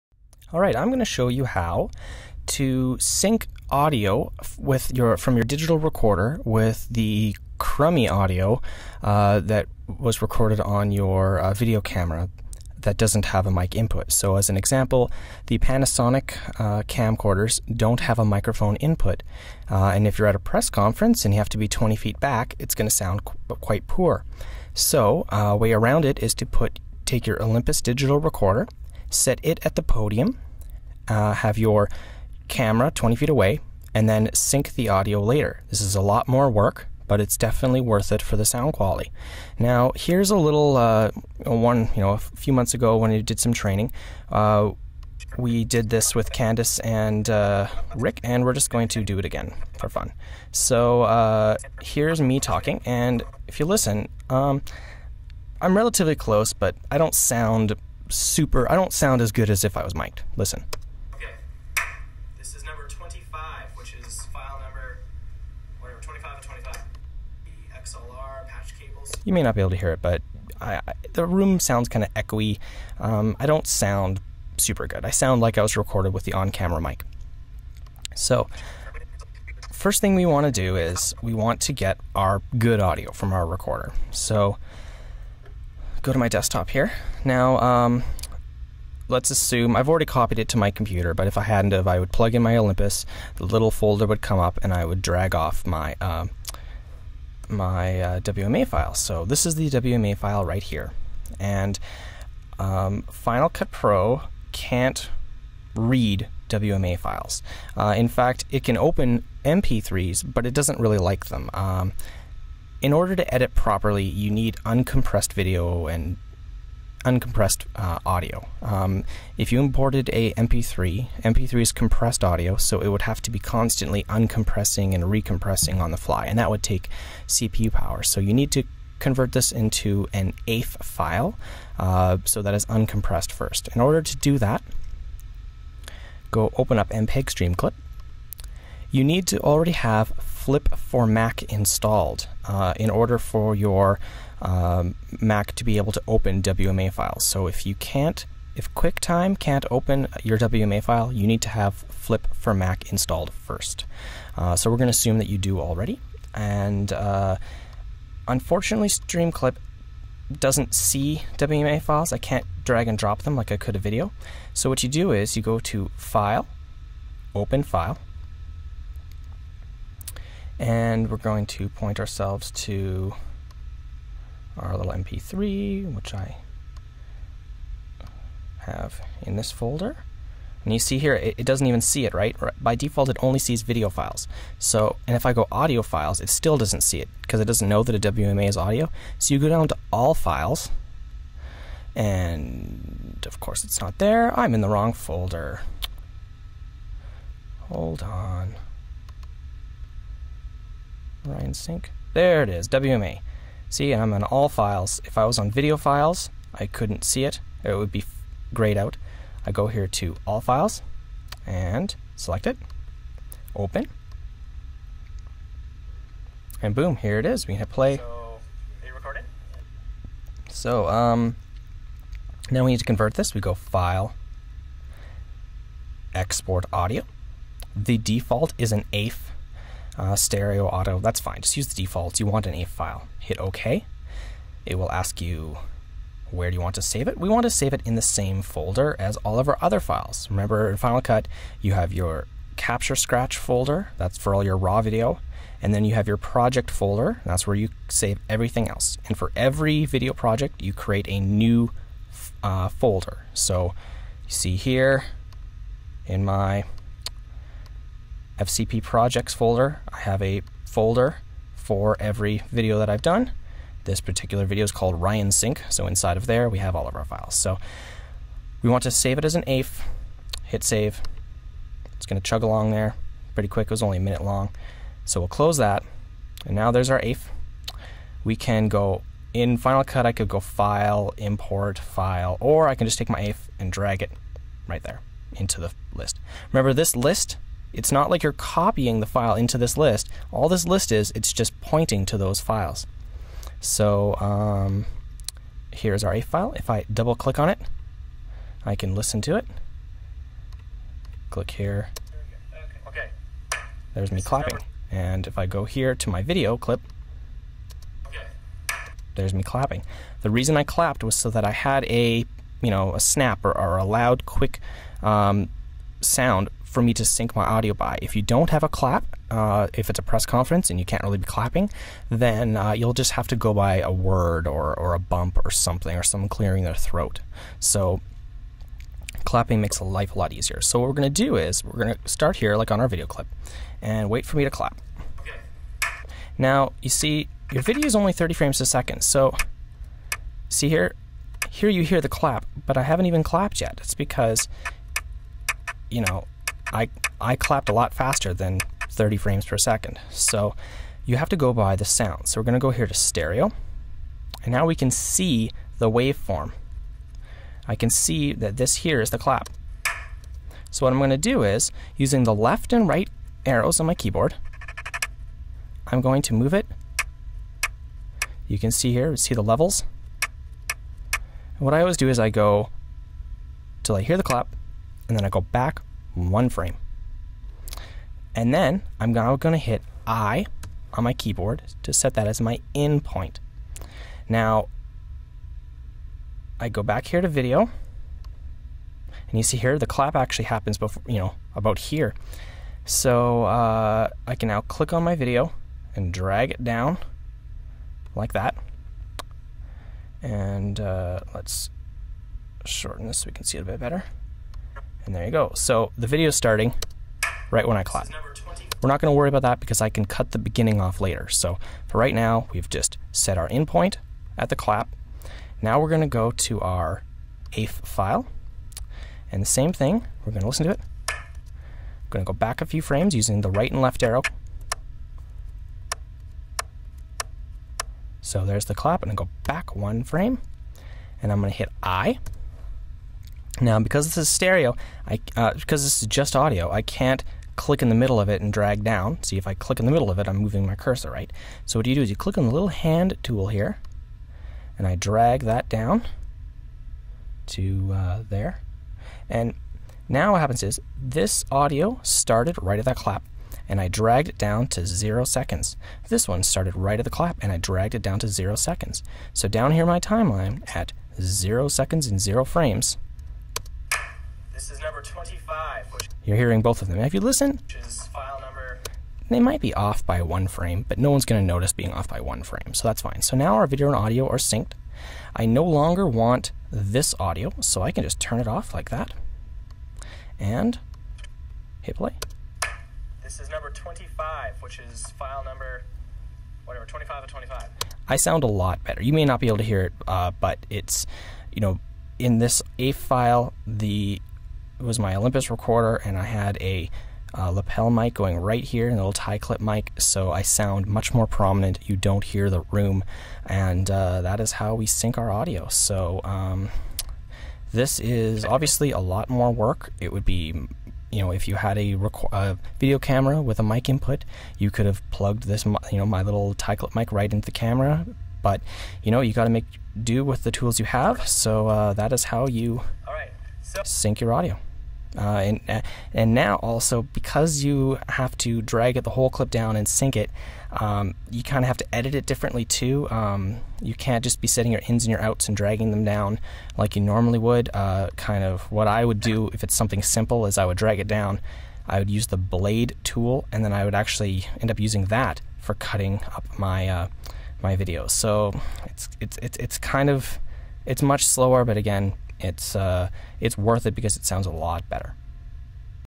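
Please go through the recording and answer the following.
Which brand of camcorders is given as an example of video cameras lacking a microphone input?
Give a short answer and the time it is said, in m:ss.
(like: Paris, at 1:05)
Panasonic, at 0:15.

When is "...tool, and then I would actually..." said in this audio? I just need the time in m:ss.
9:03.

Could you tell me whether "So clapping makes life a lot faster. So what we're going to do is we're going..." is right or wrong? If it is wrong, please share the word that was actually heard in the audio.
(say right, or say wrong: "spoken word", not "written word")
wrong: "easier", not "faster".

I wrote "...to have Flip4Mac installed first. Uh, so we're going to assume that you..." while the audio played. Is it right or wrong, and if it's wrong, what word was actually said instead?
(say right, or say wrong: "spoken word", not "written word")
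right.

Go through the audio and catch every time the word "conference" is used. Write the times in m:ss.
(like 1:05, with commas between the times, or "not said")
0:20, 5:20.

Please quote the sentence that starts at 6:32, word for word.
So uh, I can now click on my video and drag it down like that.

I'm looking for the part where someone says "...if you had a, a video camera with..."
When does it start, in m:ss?
8:31.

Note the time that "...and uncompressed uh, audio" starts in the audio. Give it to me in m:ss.
1:55.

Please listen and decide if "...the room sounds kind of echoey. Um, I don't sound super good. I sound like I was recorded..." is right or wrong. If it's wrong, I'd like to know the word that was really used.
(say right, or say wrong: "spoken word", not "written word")
right.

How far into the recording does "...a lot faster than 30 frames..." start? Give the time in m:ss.
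5:47.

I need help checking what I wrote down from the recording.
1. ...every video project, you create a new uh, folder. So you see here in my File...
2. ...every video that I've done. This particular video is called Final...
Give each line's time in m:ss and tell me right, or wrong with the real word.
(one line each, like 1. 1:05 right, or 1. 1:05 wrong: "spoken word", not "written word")
1. 4:09 wrong: "FCP", not "File"
2. 4:21 wrong: "Ryan", not "Final".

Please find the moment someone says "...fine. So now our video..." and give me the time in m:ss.
7:53.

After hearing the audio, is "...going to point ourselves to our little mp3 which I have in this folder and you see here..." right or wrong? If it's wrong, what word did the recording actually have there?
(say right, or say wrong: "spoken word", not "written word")
right.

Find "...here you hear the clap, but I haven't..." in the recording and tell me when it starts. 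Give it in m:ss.
5:41.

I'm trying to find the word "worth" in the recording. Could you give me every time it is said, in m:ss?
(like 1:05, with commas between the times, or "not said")
0:37, 9:13.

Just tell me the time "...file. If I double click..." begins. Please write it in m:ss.
4:56.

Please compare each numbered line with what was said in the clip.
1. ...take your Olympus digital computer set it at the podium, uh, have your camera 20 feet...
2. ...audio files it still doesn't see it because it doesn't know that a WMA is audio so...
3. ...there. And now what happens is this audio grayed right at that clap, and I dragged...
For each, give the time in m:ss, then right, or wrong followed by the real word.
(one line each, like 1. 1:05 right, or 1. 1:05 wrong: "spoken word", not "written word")
1. 0:27 wrong: "recorder", not "computer"
2. 3:05 right
3. 7:28 wrong: "started", not "grayed".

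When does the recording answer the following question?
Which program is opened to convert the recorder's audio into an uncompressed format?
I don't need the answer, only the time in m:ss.
2:16.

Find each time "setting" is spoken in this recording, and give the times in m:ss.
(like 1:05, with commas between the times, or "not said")
8:54.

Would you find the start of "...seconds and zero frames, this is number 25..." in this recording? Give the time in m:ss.
7:41.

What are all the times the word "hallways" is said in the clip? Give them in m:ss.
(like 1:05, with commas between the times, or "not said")
not said.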